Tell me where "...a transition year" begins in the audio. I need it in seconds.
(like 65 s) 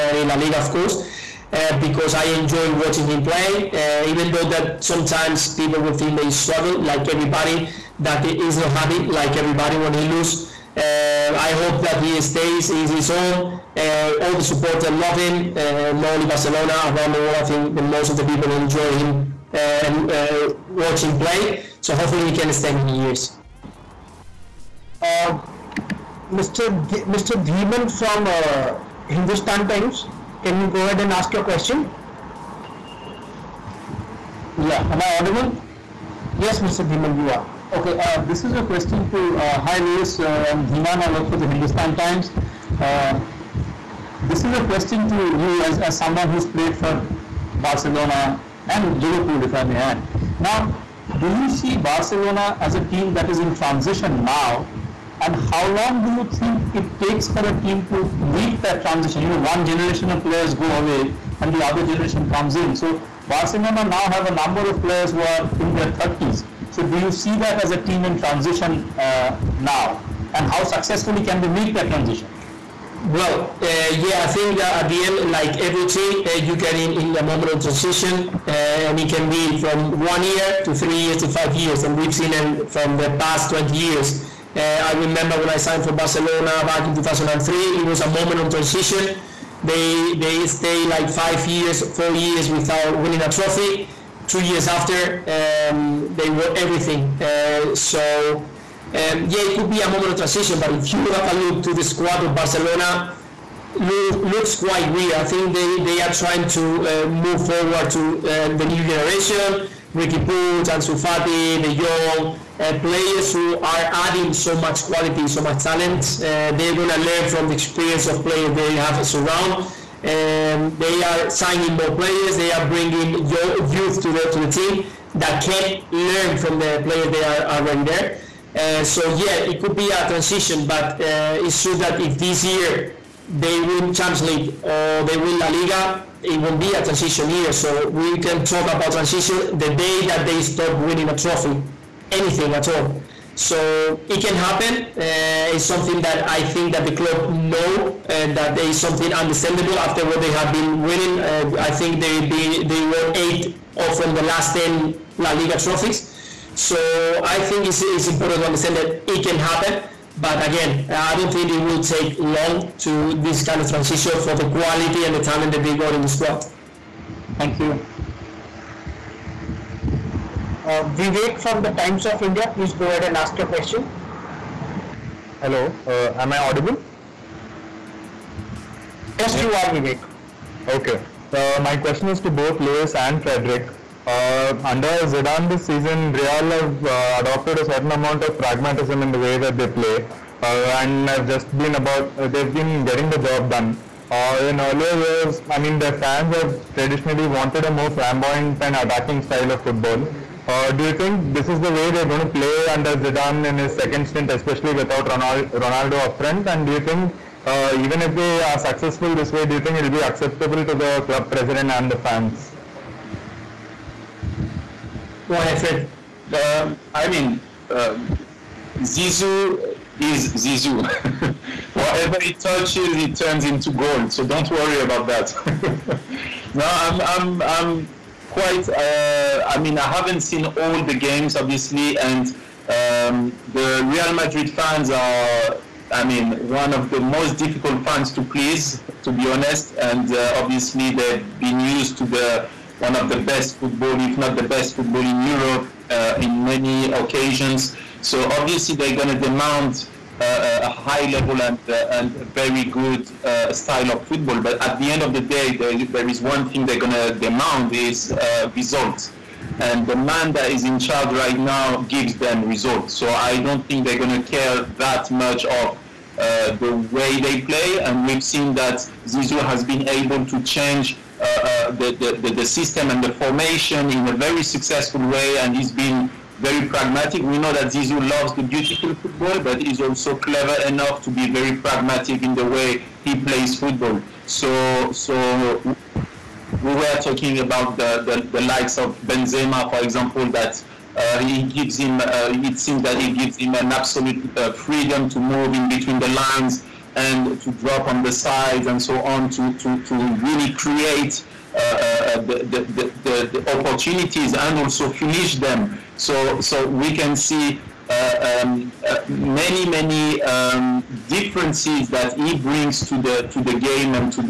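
136 s.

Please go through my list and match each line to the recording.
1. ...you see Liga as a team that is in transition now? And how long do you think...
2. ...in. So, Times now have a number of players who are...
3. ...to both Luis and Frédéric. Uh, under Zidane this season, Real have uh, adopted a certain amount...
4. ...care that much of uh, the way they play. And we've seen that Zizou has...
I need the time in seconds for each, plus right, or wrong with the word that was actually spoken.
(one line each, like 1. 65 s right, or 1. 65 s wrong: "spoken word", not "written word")
1. 51 s wrong: "Barcelona", not "Liga"
2. 62 s wrong: "Barcelona", not "Times"
3. 182 s right
4. 264 s right.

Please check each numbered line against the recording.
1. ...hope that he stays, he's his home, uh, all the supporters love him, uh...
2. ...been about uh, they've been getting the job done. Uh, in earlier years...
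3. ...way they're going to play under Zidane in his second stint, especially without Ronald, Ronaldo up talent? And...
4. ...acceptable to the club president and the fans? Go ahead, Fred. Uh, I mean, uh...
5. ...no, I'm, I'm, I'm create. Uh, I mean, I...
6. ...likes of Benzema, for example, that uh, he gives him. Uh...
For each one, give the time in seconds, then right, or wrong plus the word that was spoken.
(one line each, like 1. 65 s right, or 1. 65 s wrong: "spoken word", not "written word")
1. 11 s right
2. 191 s right
3. 201 s wrong: "front", not "talent"
4. 210 s right
5. 226 s wrong: "quite", not "create"
6. 288 s right.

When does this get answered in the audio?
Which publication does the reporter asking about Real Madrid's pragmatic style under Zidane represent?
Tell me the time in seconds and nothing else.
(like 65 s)
171 s.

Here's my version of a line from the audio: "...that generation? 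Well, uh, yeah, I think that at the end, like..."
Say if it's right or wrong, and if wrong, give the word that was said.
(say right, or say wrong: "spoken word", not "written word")
wrong: "transition", not "generation".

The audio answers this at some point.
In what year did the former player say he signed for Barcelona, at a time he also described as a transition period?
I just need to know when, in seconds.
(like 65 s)
86 s.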